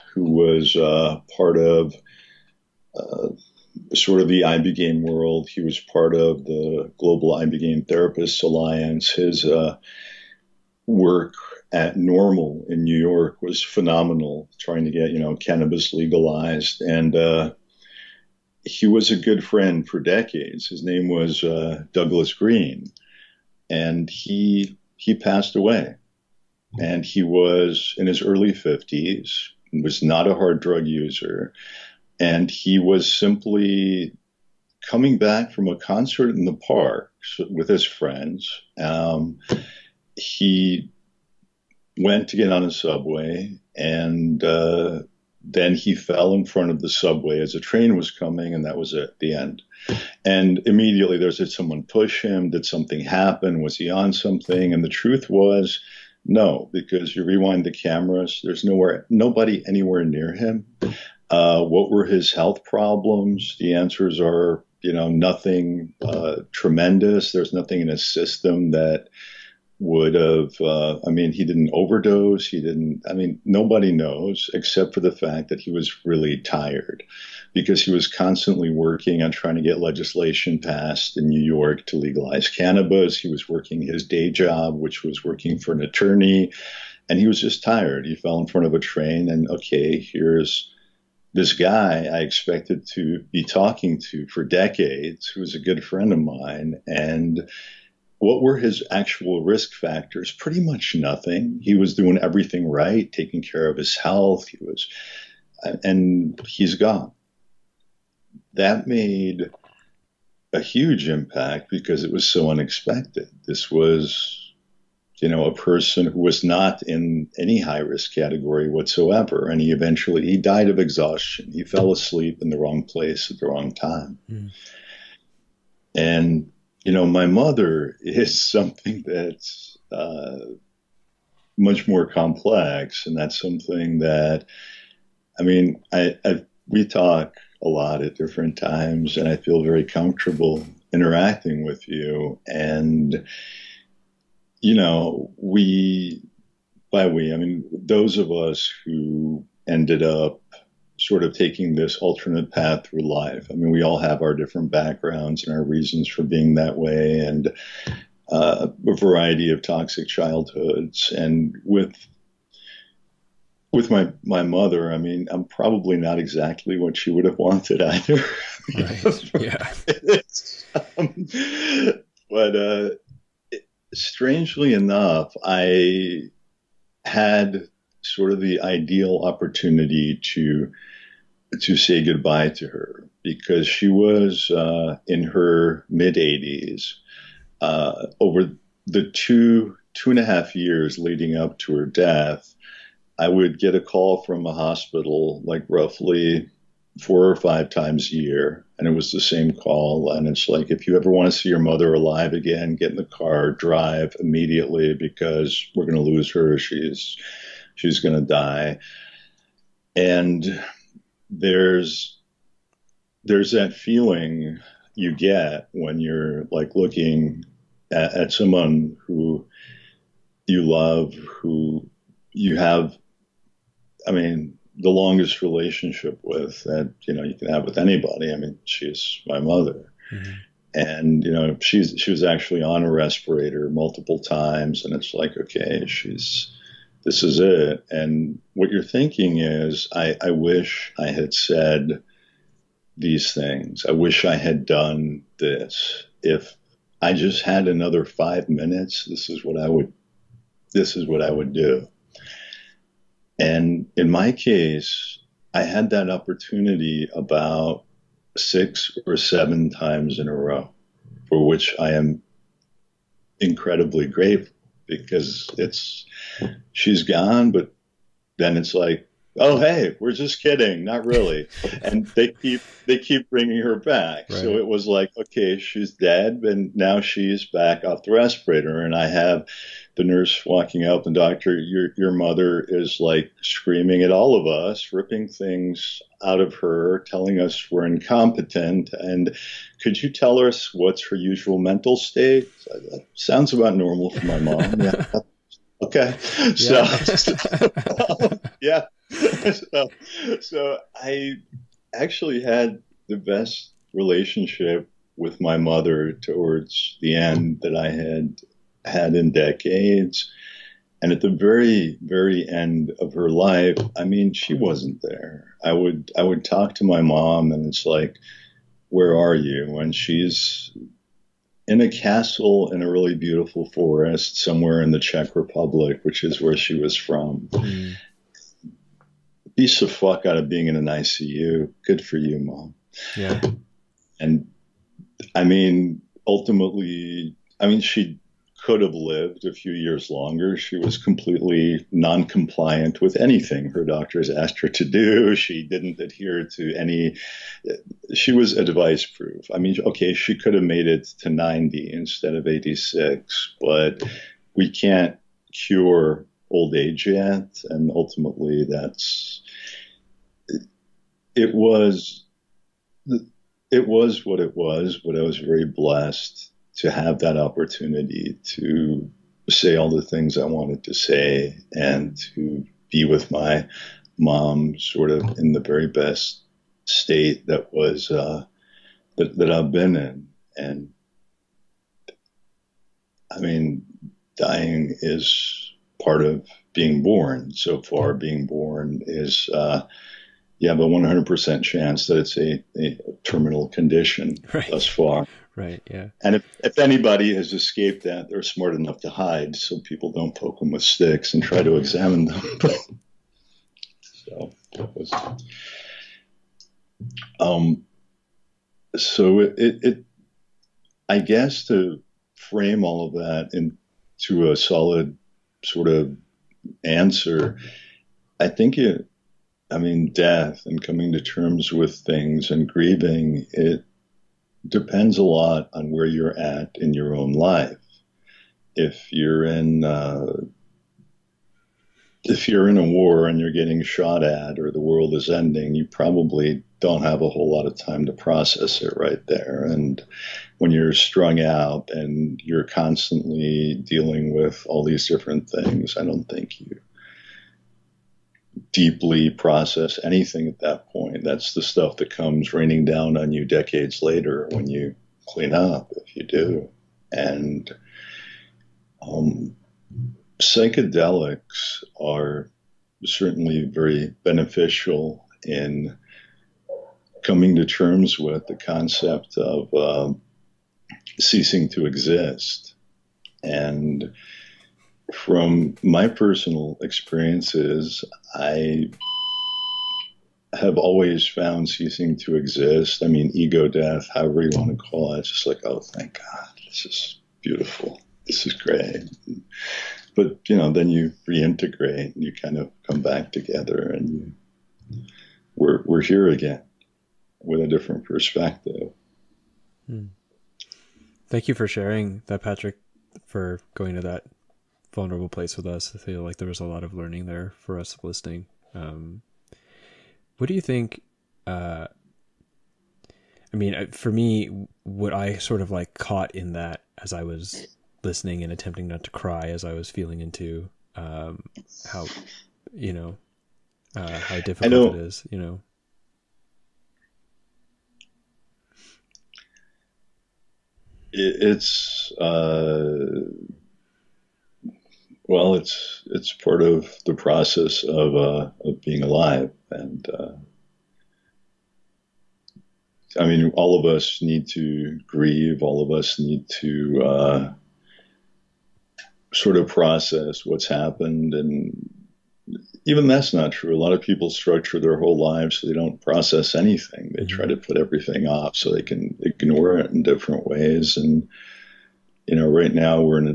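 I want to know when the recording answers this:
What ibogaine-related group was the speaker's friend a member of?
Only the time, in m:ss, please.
0:06.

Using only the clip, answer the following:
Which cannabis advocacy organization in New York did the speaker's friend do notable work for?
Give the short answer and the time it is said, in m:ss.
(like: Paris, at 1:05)
NORML, at 0:11.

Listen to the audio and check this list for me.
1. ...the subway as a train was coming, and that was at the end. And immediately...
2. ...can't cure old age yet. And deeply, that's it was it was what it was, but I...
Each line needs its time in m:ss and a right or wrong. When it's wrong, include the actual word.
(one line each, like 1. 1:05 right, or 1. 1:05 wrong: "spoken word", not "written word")
1. 0:46 right
2. 5:54 wrong: "ultimately", not "deeply".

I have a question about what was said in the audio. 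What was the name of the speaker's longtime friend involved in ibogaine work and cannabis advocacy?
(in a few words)
Douglas Green.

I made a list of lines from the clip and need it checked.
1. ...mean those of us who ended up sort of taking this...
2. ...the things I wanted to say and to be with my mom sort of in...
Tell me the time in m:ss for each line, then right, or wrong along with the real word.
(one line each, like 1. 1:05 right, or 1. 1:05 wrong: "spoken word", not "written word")
1. 2:27 right
2. 6:09 right.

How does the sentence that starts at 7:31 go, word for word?
That's the stuff that comes raining down on you decades later when you clean up, if you do.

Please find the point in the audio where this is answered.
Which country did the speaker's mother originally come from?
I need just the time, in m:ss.
5:24.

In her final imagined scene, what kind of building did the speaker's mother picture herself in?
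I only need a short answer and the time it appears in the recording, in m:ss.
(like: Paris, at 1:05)
A castle, at 5:21.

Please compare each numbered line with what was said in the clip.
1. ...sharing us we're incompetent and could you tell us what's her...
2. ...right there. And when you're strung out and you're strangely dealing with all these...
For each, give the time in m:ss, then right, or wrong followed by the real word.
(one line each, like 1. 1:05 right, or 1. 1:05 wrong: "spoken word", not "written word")
1. 4:46 wrong: "telling", not "sharing"
2. 7:18 wrong: "constantly", not "strangely".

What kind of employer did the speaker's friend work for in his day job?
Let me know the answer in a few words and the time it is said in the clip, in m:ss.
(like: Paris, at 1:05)
An attorney, at 1:25.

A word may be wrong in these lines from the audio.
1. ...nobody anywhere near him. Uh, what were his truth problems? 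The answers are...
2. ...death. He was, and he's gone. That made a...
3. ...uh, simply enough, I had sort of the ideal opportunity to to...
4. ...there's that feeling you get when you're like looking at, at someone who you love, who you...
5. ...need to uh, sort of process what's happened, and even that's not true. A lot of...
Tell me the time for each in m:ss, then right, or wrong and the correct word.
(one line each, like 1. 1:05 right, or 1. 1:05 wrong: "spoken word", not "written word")
1. 0:59 wrong: "health", not "truth"
2. 1:43 wrong: "health", not "death"
3. 2:52 wrong: "strangely", not "simply"
4. 3:33 right
5. 9:06 right.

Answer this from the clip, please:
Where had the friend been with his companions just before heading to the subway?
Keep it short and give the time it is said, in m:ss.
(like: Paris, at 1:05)
A concert in the park, at 0:35.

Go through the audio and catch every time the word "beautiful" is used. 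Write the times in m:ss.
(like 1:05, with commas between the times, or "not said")
5:23, 8:07.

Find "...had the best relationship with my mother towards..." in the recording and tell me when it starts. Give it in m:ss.
5:02.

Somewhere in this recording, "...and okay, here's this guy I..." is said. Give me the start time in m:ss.
1:29.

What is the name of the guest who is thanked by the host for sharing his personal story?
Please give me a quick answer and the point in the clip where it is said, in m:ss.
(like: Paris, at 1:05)
Patrick, at 8:22.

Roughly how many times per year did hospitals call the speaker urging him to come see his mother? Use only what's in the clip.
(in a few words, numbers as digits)
4 or 5.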